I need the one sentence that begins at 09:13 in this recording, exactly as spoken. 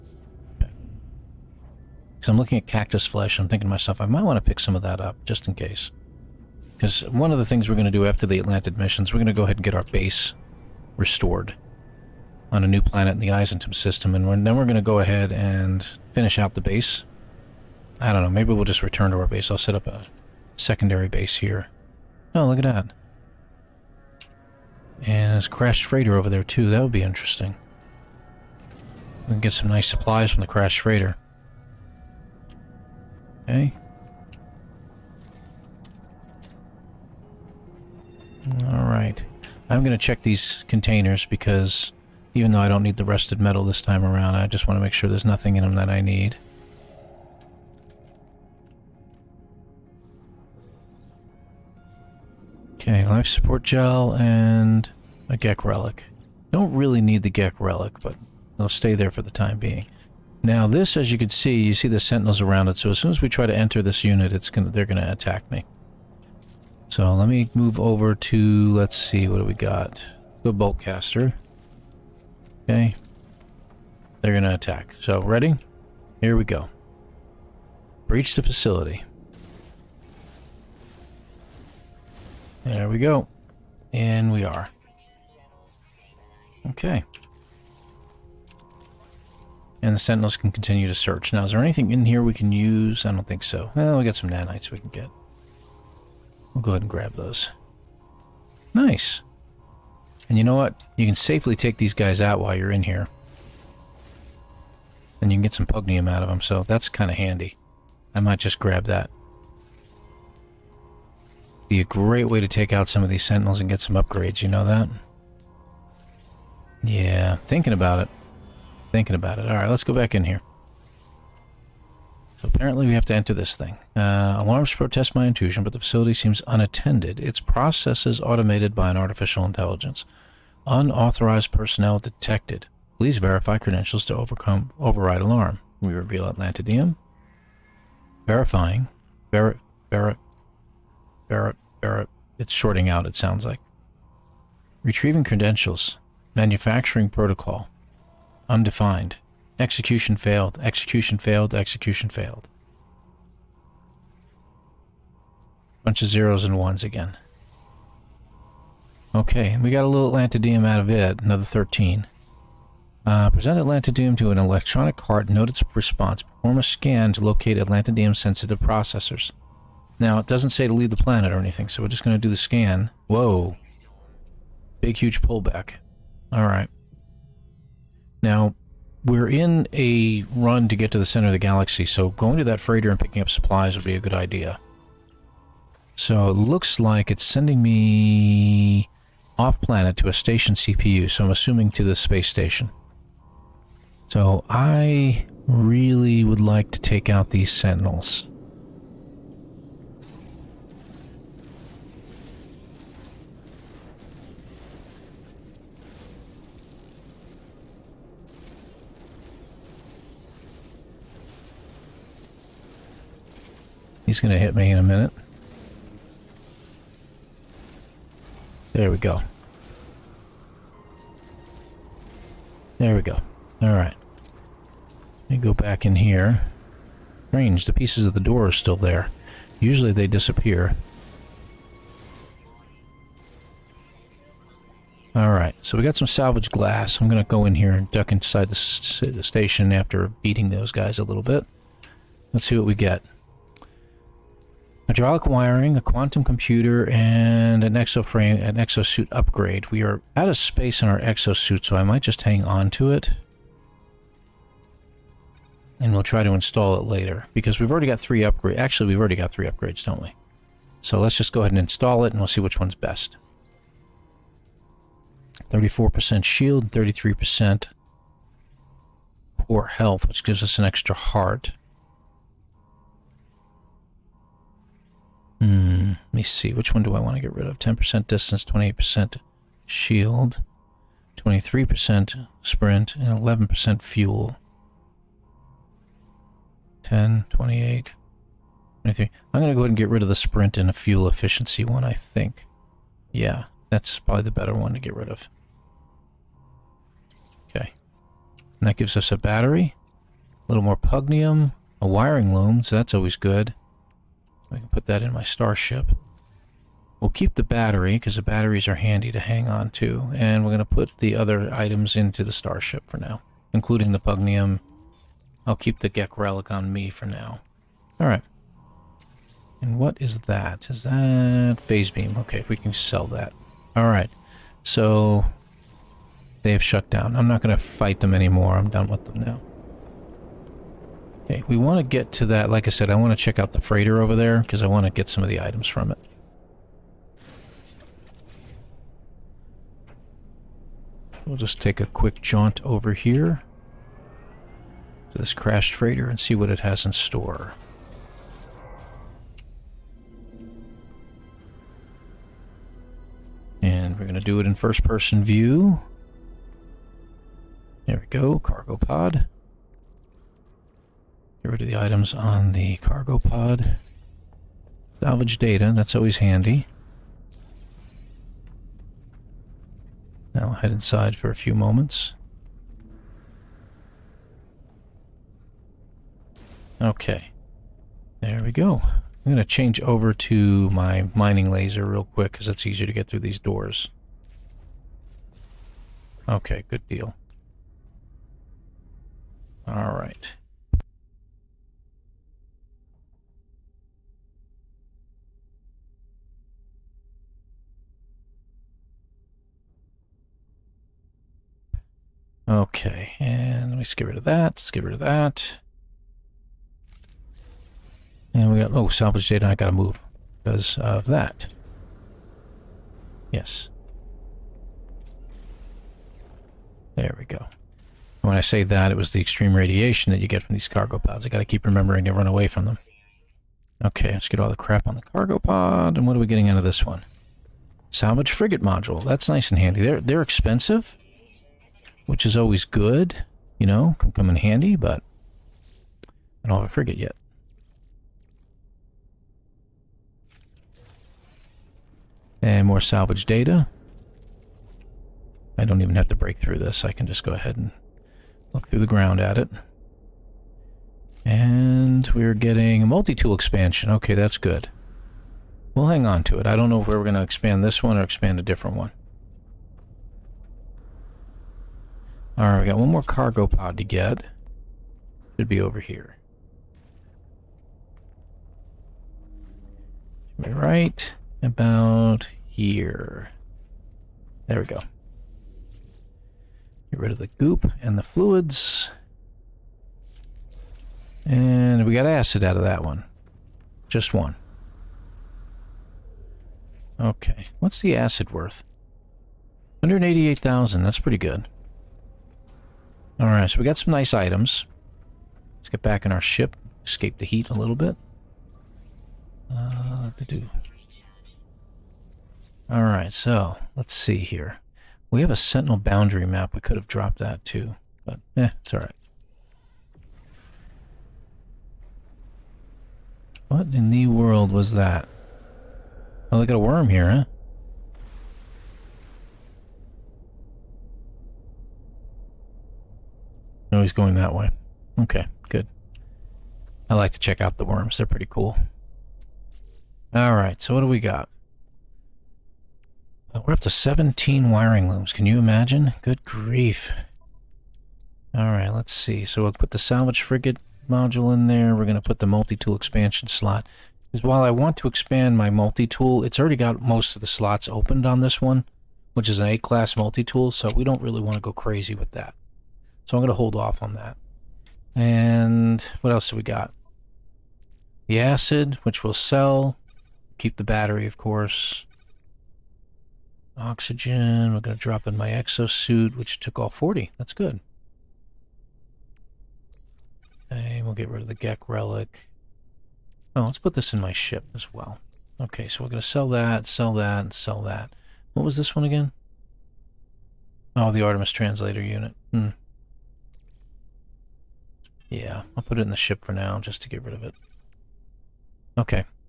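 So I'm going to hold off on that.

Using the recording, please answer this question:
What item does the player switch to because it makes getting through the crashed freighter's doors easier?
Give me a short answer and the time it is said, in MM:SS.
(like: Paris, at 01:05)
Mining laser, at 06:21.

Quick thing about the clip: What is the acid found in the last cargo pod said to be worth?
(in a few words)
188,000.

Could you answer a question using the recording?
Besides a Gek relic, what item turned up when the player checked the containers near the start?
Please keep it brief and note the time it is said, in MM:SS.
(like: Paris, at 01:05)
Life support gel, at 00:53.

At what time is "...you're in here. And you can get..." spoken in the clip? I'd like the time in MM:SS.
01:42.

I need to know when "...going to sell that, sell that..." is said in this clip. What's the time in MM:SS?
09:35.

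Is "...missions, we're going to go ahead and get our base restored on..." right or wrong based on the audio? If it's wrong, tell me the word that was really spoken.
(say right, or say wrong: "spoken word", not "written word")
right.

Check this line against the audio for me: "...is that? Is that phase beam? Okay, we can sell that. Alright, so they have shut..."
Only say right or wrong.
right.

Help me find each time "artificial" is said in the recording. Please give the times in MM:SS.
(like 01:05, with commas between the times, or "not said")
02:08.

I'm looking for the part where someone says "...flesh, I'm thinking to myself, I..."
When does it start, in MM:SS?
00:03.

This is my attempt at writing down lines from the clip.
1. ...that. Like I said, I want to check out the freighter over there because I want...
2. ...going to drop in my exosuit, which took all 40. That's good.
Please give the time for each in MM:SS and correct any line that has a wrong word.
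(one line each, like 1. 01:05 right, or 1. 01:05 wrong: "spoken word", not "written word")
1. 05:32 right
2. 09:24 right.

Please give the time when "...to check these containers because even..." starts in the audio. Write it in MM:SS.
00:39.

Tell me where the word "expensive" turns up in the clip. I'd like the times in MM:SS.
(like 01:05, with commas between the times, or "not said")
07:10.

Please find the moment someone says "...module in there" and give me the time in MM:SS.
09:00.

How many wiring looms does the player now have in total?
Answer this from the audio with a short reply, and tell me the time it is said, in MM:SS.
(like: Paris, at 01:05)
17, at 08:53.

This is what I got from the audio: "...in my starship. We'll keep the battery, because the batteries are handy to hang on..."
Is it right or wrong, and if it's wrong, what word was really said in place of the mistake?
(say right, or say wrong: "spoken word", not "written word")
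right.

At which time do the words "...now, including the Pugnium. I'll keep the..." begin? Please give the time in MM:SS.
05:12.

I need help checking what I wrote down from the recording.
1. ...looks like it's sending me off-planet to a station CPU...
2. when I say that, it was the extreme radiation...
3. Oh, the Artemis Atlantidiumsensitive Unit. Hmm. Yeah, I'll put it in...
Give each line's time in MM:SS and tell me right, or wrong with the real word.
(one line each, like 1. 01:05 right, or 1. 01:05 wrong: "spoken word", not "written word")
1. 03:06 right
2. 06:58 right
3. 09:40 wrong: "Translator", not "Atlantidiumsensitive".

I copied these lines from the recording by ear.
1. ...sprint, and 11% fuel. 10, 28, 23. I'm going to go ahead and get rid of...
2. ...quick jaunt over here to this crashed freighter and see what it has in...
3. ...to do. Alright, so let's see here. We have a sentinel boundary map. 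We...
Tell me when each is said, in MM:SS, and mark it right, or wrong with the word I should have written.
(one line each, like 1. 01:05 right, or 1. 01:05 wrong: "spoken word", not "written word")
1. 04:42 right
2. 05:41 right
3. 08:20 right.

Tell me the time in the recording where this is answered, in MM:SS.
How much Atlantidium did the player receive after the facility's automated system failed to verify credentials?
02:41.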